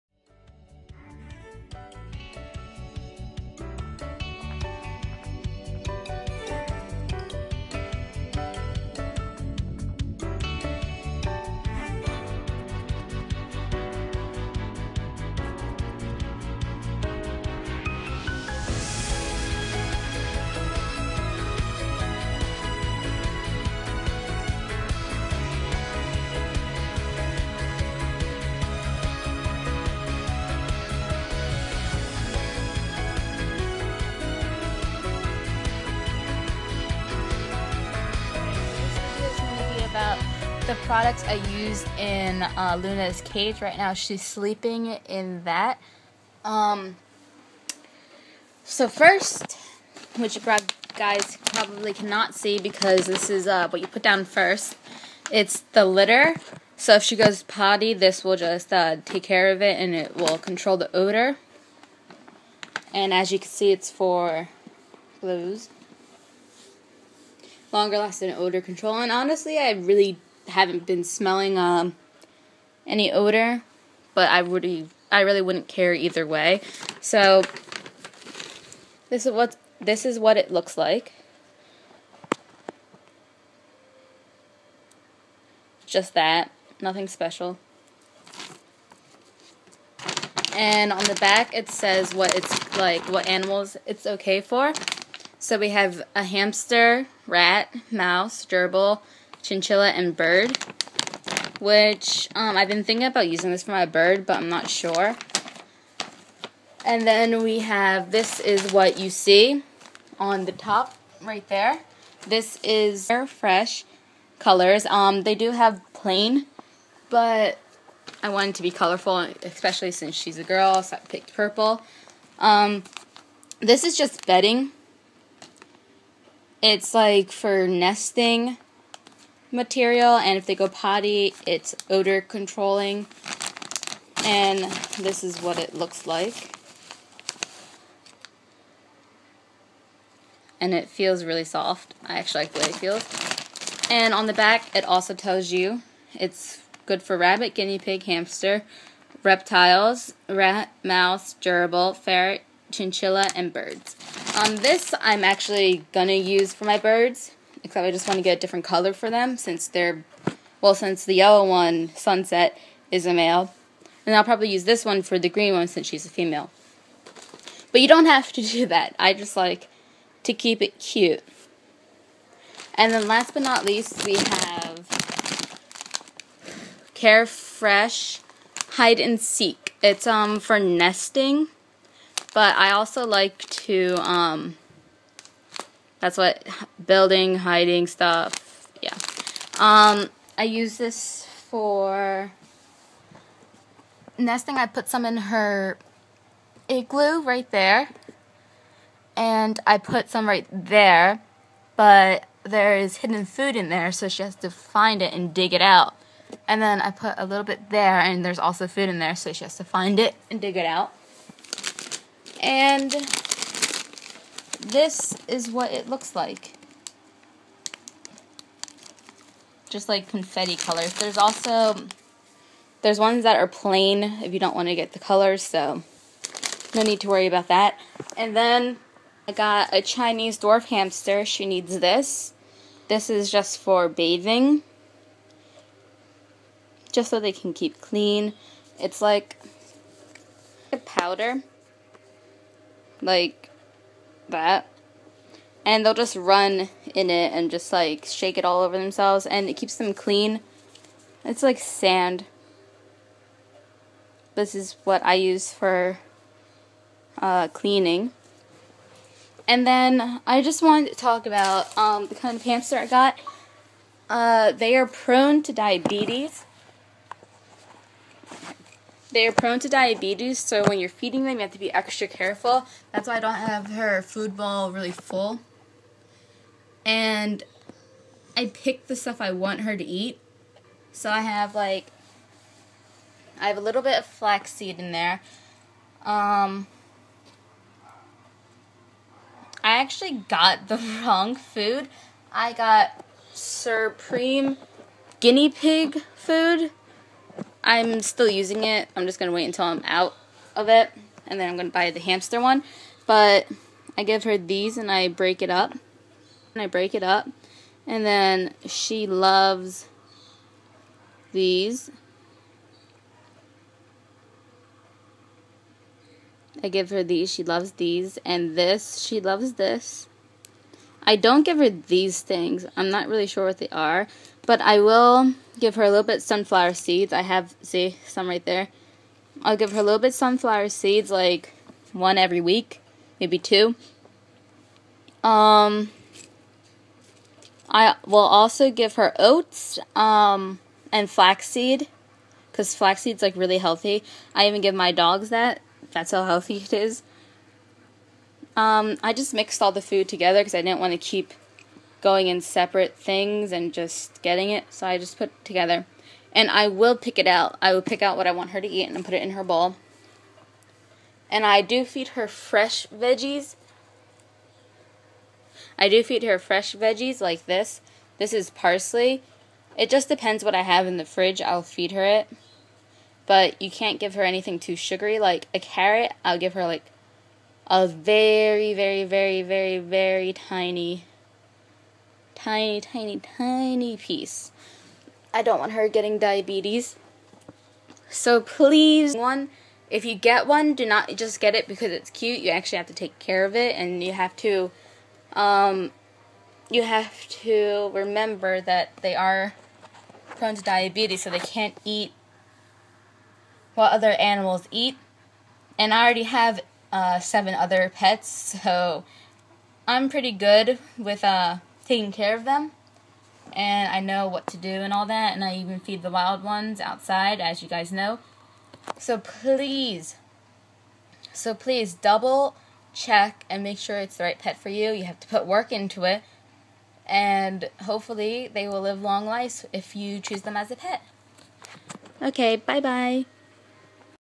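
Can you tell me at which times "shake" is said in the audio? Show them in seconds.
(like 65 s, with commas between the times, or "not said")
248 s.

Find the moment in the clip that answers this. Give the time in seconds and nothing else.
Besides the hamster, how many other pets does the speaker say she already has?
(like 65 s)
407 s.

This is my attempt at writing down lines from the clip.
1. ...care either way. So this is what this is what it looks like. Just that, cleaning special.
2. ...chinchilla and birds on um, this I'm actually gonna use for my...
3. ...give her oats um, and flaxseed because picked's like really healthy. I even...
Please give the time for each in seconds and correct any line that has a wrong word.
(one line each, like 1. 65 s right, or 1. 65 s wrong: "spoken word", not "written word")
1. 75 s wrong: "nothing", not "cleaning"
2. 152 s right
3. 338 s wrong: "flaxseed", not "picked".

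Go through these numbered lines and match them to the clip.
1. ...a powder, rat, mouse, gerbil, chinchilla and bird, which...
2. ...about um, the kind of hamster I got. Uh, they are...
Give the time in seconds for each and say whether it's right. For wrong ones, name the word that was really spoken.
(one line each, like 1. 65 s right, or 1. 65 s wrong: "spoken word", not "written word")
1. 96 s wrong: "hamster", not "powder"
2. 261 s right.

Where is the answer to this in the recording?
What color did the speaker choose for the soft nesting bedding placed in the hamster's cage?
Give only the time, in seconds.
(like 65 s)
121 s.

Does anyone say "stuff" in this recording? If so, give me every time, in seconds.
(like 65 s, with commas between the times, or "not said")
187 s, 278 s.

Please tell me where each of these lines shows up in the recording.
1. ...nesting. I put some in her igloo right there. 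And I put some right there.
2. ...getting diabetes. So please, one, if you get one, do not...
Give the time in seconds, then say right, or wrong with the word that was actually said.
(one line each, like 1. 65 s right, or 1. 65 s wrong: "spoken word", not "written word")
1. 194 s right
2. 385 s right.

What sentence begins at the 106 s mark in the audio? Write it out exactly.
And then we have, this is what you see on the top right there.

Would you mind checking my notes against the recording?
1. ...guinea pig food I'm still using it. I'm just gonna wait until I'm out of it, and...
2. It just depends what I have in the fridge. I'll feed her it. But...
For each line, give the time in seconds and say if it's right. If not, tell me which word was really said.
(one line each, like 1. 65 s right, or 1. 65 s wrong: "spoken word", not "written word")
1. 295 s right
2. 369 s right.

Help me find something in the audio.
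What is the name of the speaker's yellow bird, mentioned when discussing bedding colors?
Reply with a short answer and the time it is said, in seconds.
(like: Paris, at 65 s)
Sunset, at 161 s.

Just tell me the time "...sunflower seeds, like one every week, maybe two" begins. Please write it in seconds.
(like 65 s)
330 s.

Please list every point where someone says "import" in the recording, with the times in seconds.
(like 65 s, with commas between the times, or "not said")
not said.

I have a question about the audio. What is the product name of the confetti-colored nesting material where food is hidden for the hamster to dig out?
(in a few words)
Carefresh Hide and Seek.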